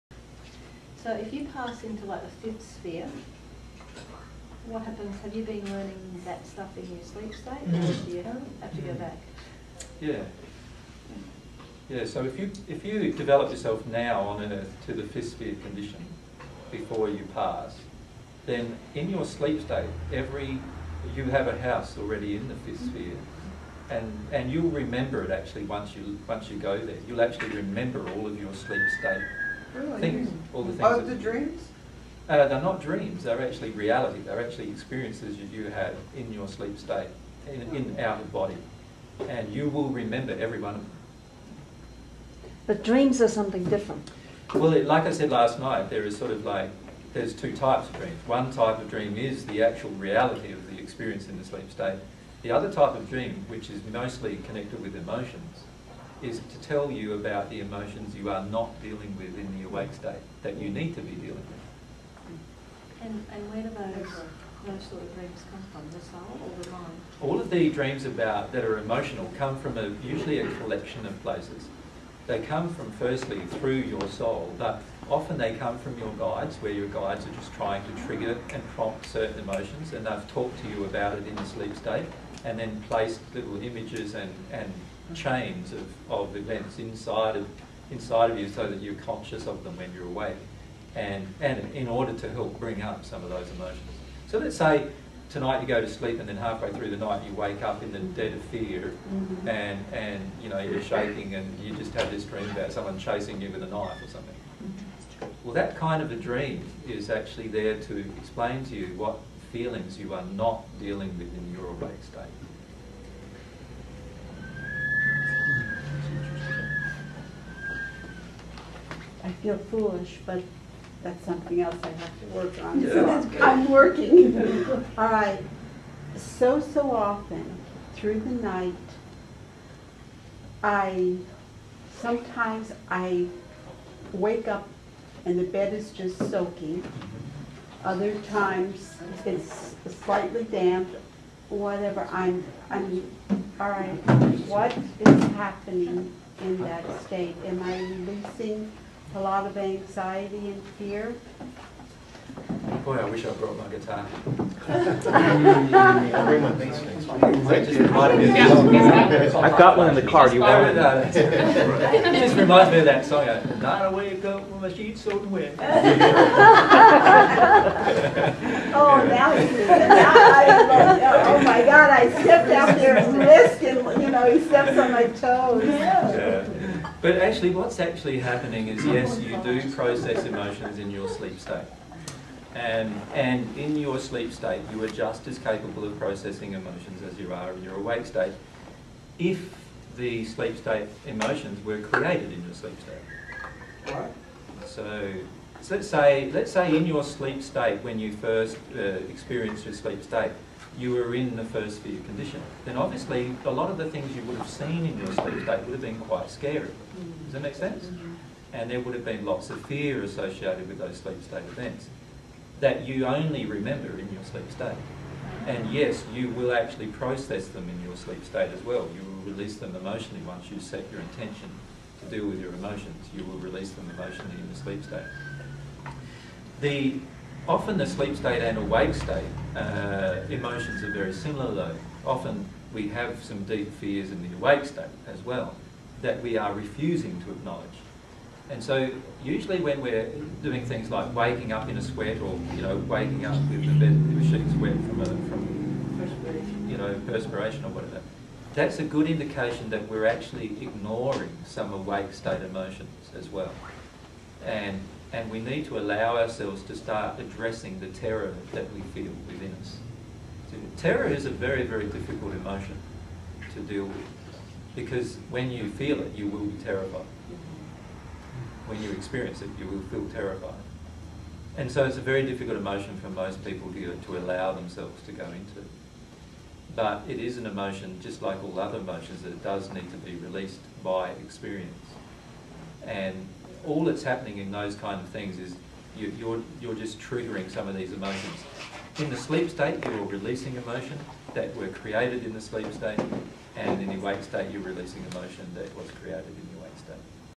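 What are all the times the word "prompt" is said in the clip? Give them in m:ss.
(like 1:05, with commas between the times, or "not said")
1:18.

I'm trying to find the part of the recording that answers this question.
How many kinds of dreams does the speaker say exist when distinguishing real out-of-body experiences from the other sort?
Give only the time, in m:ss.
0:47.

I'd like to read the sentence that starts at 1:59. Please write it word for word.
I feel foolish, but that's something else I have to work on.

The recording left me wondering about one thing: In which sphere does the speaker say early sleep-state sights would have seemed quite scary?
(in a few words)
first sphere.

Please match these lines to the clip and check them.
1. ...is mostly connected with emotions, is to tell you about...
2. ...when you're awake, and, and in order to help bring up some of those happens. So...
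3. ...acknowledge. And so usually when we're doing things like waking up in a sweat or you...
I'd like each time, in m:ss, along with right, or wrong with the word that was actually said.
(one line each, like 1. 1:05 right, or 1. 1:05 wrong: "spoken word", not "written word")
1. 0:53 right
2. 1:29 wrong: "emotions", not "happens"
3. 3:57 right.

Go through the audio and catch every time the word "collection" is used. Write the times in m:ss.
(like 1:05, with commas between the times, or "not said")
1:10.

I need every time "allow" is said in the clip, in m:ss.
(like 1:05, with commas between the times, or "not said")
4:15, 4:34.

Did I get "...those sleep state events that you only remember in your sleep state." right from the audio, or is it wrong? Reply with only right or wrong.
right.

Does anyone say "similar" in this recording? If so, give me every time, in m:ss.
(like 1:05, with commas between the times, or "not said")
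3:51.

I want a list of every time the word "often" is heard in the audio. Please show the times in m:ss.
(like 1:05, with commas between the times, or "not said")
1:15, 2:06, 3:47, 3:52.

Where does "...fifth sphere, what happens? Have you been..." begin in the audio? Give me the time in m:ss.
0:02.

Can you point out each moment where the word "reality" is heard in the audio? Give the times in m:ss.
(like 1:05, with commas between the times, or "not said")
0:33, 0:49.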